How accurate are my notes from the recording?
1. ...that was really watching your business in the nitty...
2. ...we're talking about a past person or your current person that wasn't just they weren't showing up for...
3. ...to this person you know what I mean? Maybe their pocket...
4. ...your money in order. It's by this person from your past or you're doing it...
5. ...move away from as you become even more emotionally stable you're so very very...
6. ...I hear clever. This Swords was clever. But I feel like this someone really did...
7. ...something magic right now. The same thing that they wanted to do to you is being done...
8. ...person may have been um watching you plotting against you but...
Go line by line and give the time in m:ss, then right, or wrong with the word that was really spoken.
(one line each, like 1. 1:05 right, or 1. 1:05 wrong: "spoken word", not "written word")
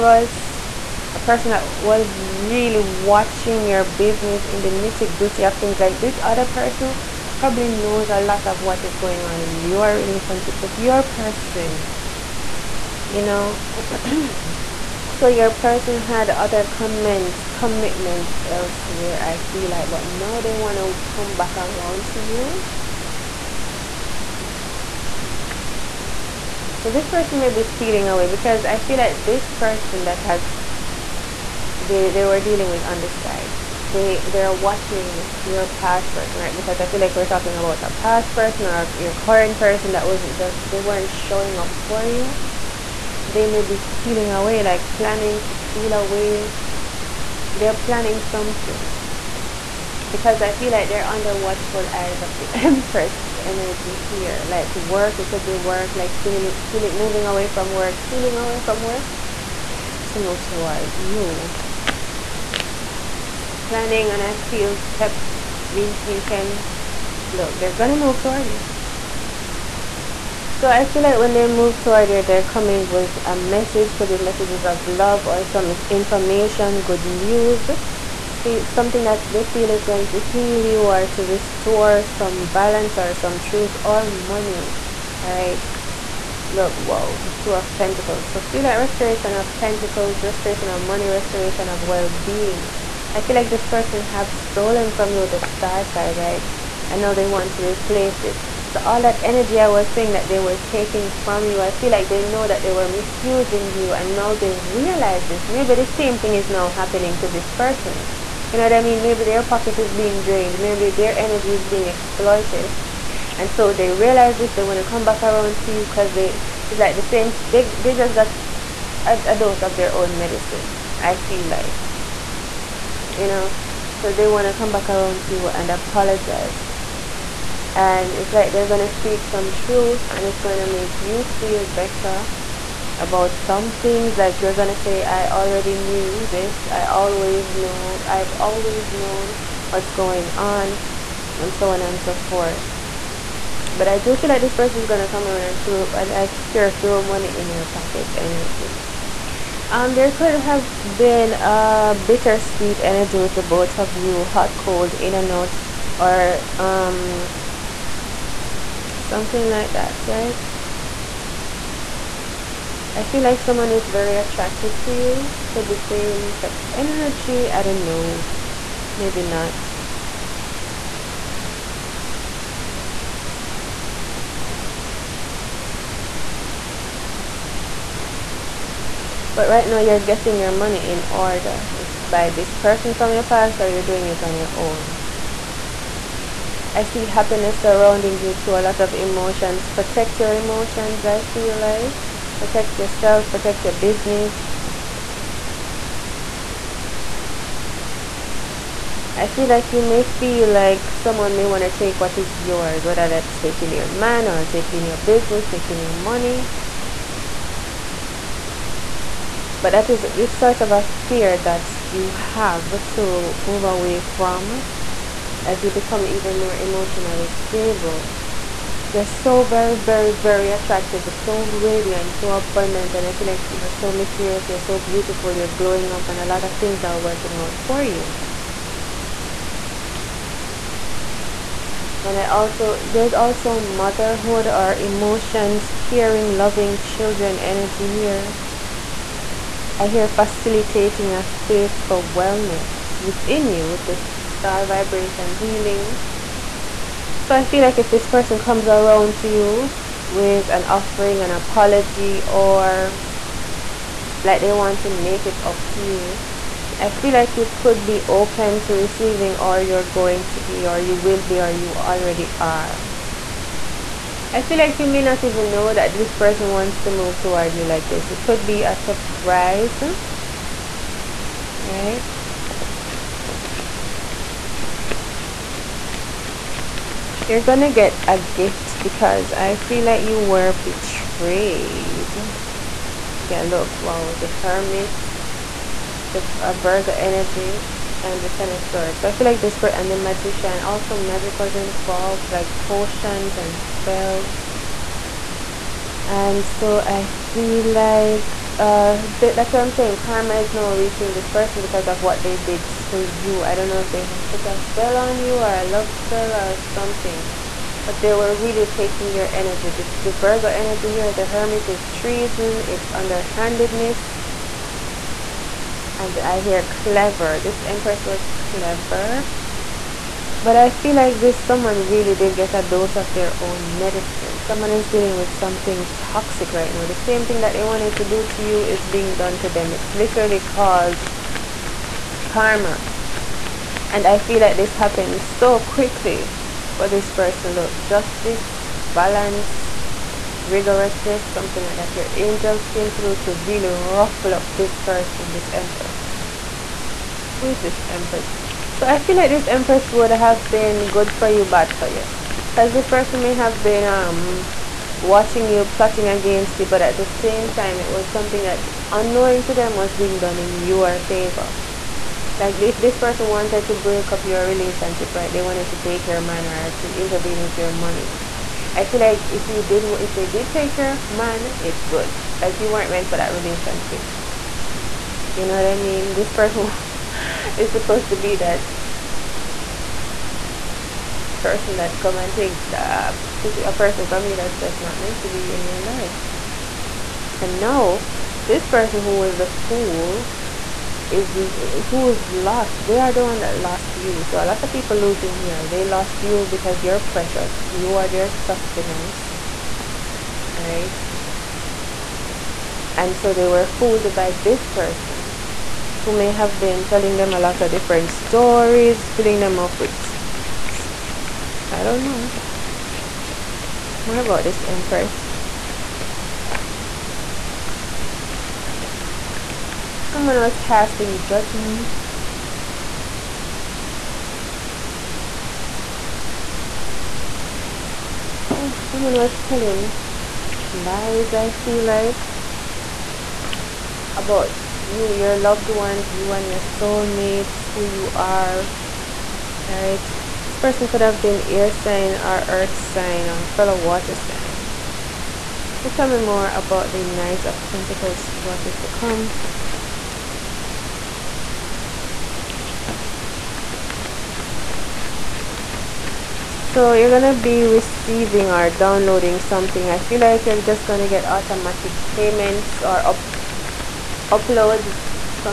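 1. 0:01 right
2. 0:37 right
3. 1:47 right
4. 3:00 right
5. 3:33 right
6. 5:16 wrong: "Empress", not "Swords"
7. 5:25 wrong: "toxic", not "magic"
8. 5:52 right.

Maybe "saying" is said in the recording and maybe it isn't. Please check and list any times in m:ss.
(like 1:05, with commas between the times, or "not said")
1:39, 4:59.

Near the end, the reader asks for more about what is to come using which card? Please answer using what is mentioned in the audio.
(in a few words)
Knight of Pentacles.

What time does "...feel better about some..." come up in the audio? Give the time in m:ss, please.
2:11.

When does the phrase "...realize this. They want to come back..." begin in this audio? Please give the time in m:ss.
1:53.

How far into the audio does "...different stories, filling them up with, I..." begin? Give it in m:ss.
6:47.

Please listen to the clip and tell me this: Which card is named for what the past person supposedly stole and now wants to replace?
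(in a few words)
The Star.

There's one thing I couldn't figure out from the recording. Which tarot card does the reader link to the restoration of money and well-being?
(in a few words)
Two of Pentacles.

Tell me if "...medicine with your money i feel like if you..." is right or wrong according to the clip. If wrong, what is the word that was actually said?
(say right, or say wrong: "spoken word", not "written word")
wrong: "intervene", not "medicine".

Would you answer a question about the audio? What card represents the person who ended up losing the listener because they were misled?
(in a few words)
The Fool.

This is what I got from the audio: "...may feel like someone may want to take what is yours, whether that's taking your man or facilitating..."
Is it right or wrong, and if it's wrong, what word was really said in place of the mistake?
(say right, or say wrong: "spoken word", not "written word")
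wrong: "taking", not "facilitating".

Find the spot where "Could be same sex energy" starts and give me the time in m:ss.
2:45.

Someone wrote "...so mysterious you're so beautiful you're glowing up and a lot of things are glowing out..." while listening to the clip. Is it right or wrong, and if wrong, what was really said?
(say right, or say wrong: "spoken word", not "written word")
wrong: "working", not "glowing".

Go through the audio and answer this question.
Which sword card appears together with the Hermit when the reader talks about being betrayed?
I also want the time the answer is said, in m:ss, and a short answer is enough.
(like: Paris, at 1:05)
Ten of Swords, at 4:48.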